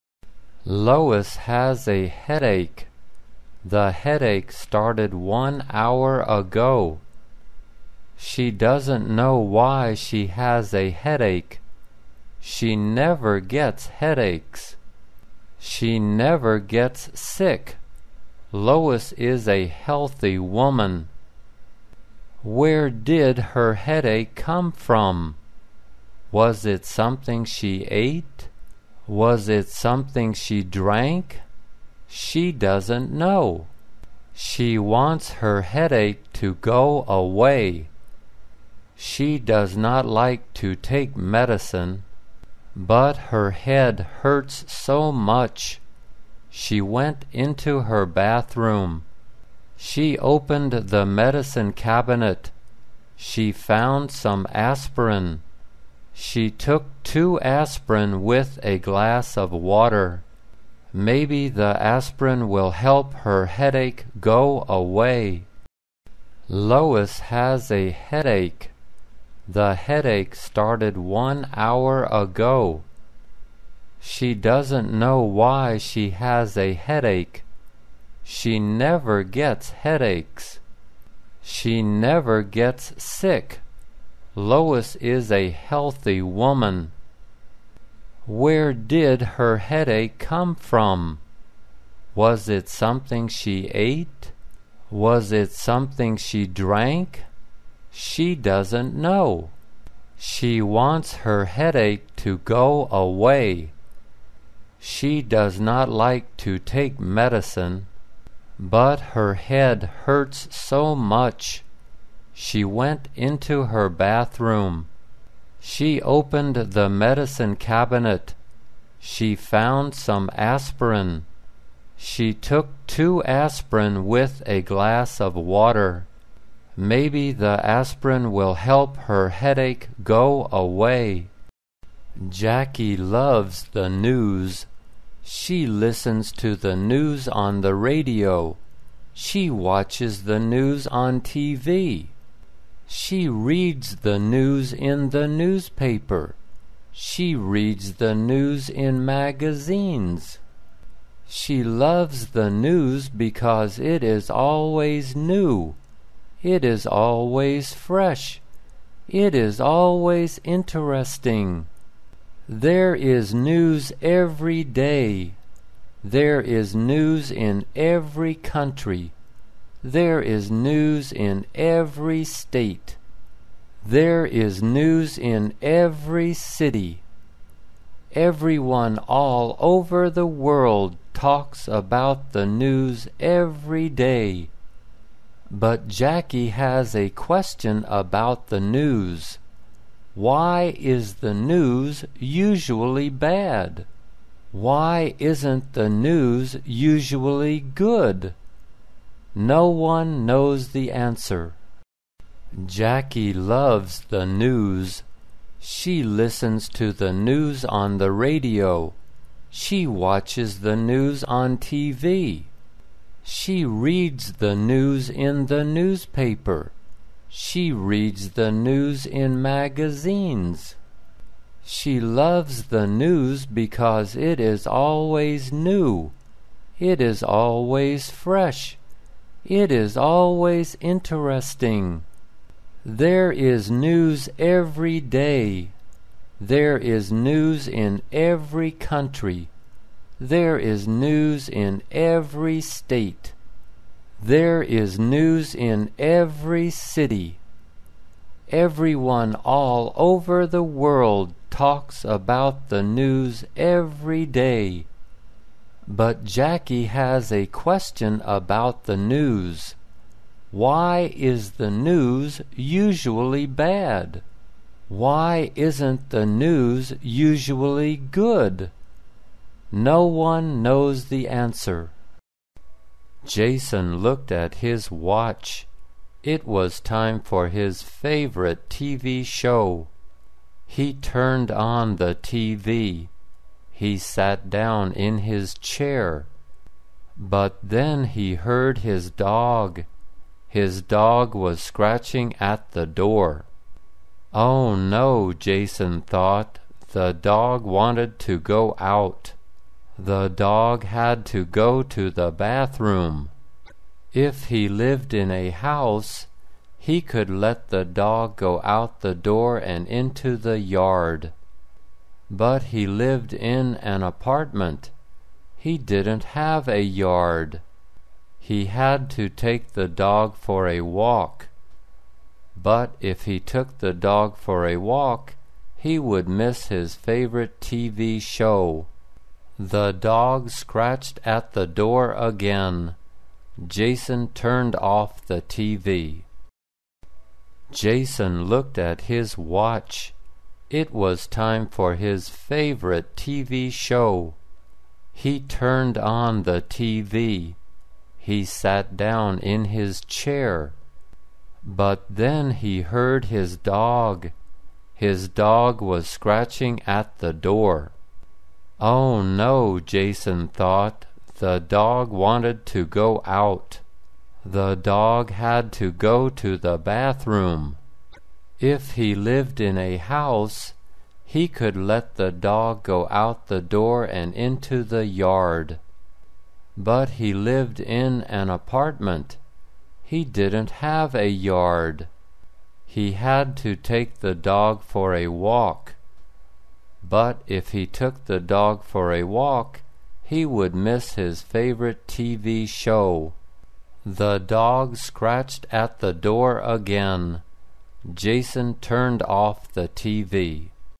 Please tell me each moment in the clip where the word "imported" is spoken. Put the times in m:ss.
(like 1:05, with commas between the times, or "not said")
not said.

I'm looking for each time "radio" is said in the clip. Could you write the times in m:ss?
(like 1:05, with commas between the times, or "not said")
2:17, 3:28.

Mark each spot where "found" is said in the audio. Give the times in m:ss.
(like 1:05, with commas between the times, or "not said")
0:53, 1:59.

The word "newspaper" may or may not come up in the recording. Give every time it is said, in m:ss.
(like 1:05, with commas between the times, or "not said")
2:25, 3:35.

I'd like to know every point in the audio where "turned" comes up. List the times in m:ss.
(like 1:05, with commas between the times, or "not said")
4:40, 5:34, 5:45, 6:38.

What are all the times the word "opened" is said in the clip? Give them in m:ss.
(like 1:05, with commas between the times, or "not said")
0:50, 1:56.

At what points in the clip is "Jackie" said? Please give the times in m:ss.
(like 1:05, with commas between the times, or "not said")
2:12, 3:05, 3:22, 4:16.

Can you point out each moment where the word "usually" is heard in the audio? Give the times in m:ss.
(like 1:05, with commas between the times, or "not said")
3:12, 3:16, 4:22, 4:27.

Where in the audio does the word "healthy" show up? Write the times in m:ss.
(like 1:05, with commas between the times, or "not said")
0:19, 1:25.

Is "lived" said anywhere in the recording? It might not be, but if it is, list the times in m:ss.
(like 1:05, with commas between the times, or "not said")
5:04, 5:12, 6:09, 6:17.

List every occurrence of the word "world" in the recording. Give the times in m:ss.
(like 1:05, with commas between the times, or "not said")
3:00, 4:10.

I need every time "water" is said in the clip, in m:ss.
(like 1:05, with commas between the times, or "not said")
0:59, 2:05.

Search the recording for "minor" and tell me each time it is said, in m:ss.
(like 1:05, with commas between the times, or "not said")
not said.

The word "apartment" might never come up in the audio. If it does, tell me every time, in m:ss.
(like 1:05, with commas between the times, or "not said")
5:14, 6:18.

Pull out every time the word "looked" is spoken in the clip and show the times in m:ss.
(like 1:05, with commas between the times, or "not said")
4:34, 5:38.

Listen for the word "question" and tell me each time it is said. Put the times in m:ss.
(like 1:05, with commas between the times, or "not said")
3:07, 4:17.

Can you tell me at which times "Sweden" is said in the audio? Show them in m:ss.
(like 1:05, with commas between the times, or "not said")
not said.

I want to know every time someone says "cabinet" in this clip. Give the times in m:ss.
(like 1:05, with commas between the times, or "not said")
0:51, 1:57.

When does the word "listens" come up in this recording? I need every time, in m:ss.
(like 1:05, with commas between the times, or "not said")
2:15, 3:26.